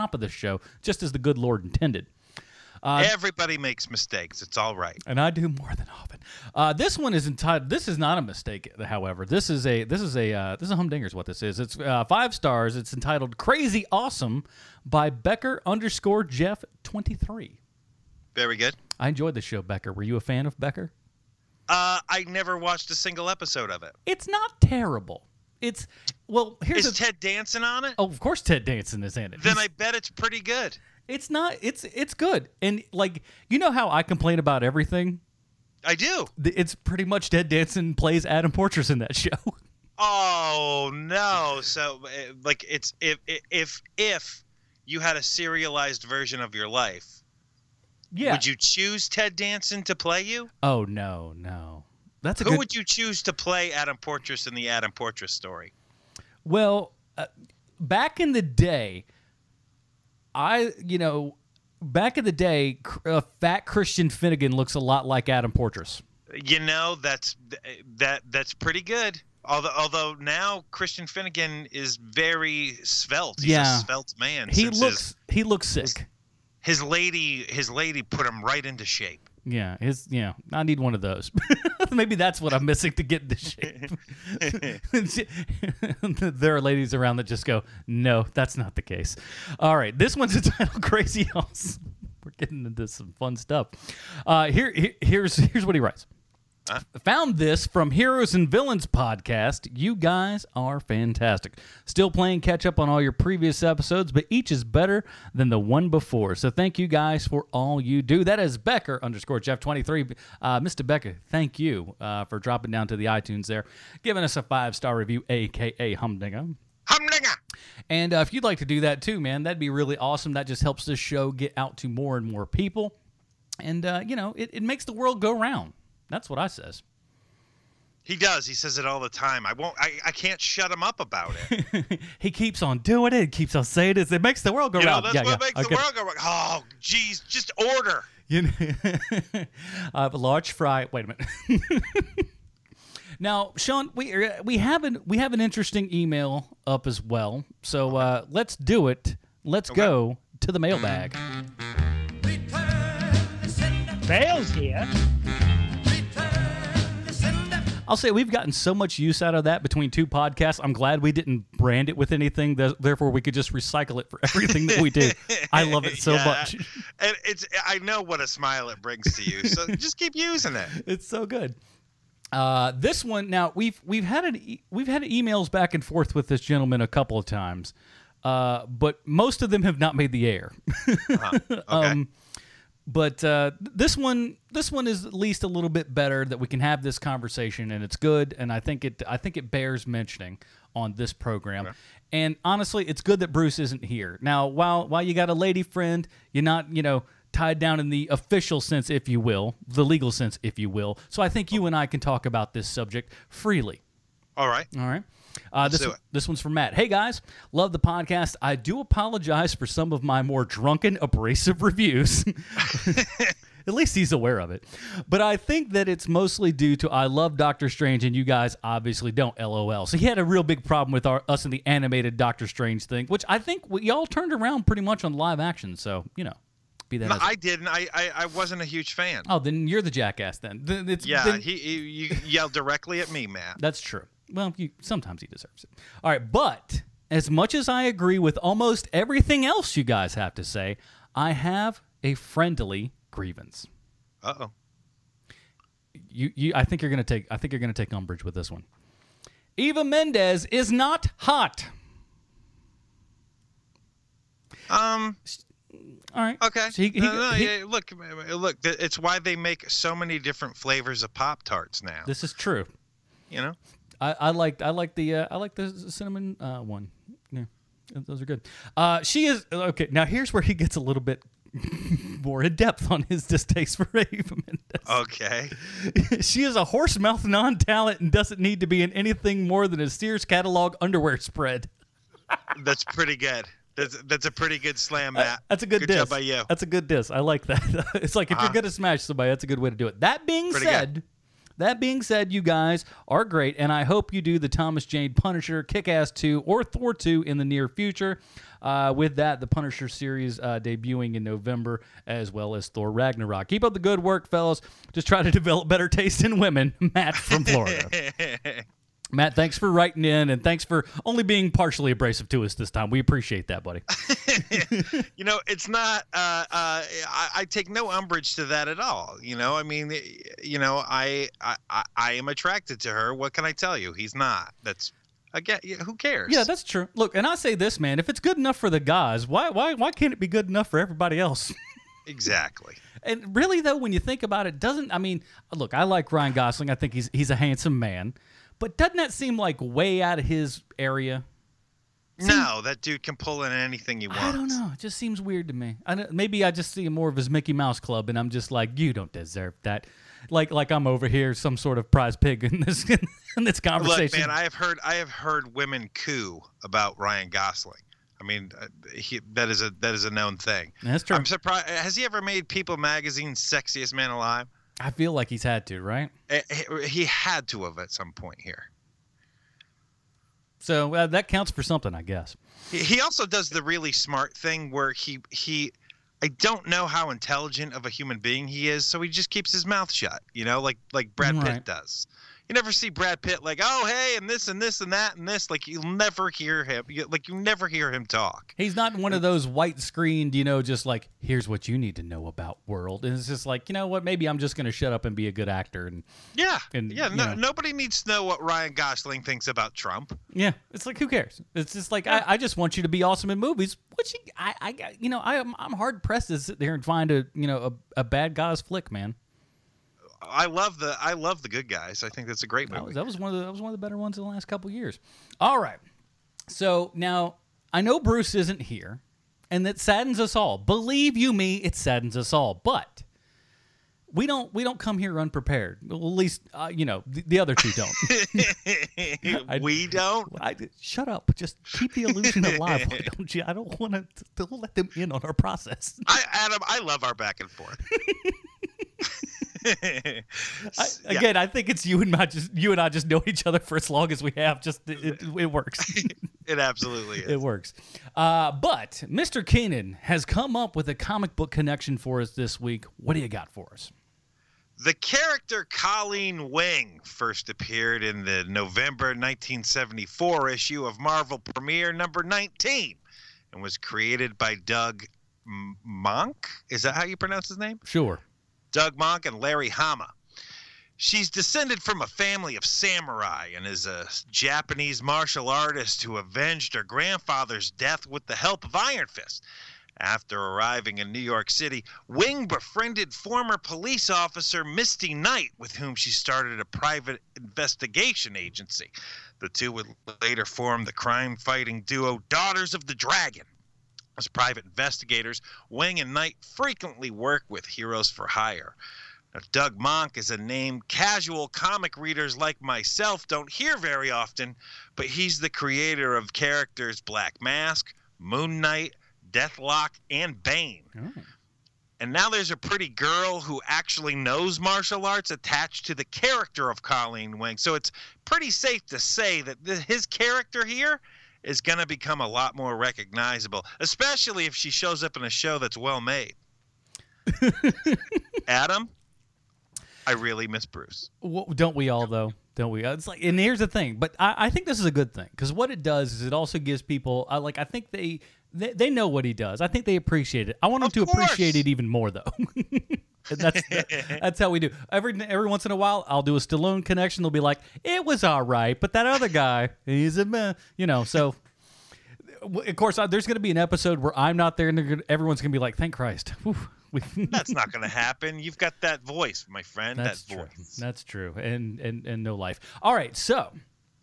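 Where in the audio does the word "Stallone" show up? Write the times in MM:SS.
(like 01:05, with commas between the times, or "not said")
09:06.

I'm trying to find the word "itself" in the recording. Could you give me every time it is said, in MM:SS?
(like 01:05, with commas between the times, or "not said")
not said.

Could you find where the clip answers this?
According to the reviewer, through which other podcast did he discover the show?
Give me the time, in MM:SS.
01:37.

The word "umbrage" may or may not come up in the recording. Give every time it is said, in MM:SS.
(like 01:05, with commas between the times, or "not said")
04:07, 05:17.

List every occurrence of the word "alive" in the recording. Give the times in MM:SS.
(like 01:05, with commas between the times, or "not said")
06:04, 07:12.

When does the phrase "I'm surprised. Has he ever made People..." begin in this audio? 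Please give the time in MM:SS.
06:01.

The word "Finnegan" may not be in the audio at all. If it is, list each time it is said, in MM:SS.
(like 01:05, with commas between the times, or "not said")
01:04, 01:11.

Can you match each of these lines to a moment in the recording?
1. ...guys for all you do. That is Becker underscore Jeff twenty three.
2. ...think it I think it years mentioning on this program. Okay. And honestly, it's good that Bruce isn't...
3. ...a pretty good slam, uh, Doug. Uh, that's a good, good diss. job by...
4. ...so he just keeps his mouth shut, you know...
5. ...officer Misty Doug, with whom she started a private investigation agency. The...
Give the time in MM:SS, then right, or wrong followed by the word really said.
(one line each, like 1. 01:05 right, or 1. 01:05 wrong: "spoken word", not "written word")
1. 01:46 right
2. 03:08 wrong: "bears", not "years"
3. 04:44 wrong: "Matt", not "Doug"
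4. 06:18 right
5. 08:04 wrong: "Knight", not "Doug".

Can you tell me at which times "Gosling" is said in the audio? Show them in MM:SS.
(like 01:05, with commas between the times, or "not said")
05:36, 05:57, 06:38.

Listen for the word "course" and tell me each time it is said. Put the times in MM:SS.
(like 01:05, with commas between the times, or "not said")
00:28, 09:01, 09:12.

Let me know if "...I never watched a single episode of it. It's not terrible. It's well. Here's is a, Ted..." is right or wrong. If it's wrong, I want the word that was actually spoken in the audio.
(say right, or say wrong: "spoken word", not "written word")
right.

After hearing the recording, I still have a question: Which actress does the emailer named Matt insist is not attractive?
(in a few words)
Eva Mendes.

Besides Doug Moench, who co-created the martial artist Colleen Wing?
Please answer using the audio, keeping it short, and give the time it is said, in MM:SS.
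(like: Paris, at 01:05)
Larry Hama, at 07:49.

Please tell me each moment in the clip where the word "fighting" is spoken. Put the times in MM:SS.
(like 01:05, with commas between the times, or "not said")
08:11.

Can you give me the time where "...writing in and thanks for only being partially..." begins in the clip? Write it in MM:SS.
05:09.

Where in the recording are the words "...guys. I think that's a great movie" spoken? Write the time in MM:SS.
06:51.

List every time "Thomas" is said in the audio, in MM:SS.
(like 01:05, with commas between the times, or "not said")
04:54.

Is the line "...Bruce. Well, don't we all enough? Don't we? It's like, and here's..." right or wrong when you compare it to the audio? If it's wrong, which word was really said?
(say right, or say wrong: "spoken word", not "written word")
wrong: "though", not "enough".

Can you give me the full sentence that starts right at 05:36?
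I think he's he's a handsome man.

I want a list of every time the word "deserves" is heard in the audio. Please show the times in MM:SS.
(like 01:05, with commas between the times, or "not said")
03:55, 05:49.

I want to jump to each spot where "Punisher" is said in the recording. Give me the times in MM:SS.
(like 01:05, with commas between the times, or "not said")
04:55, 04:59.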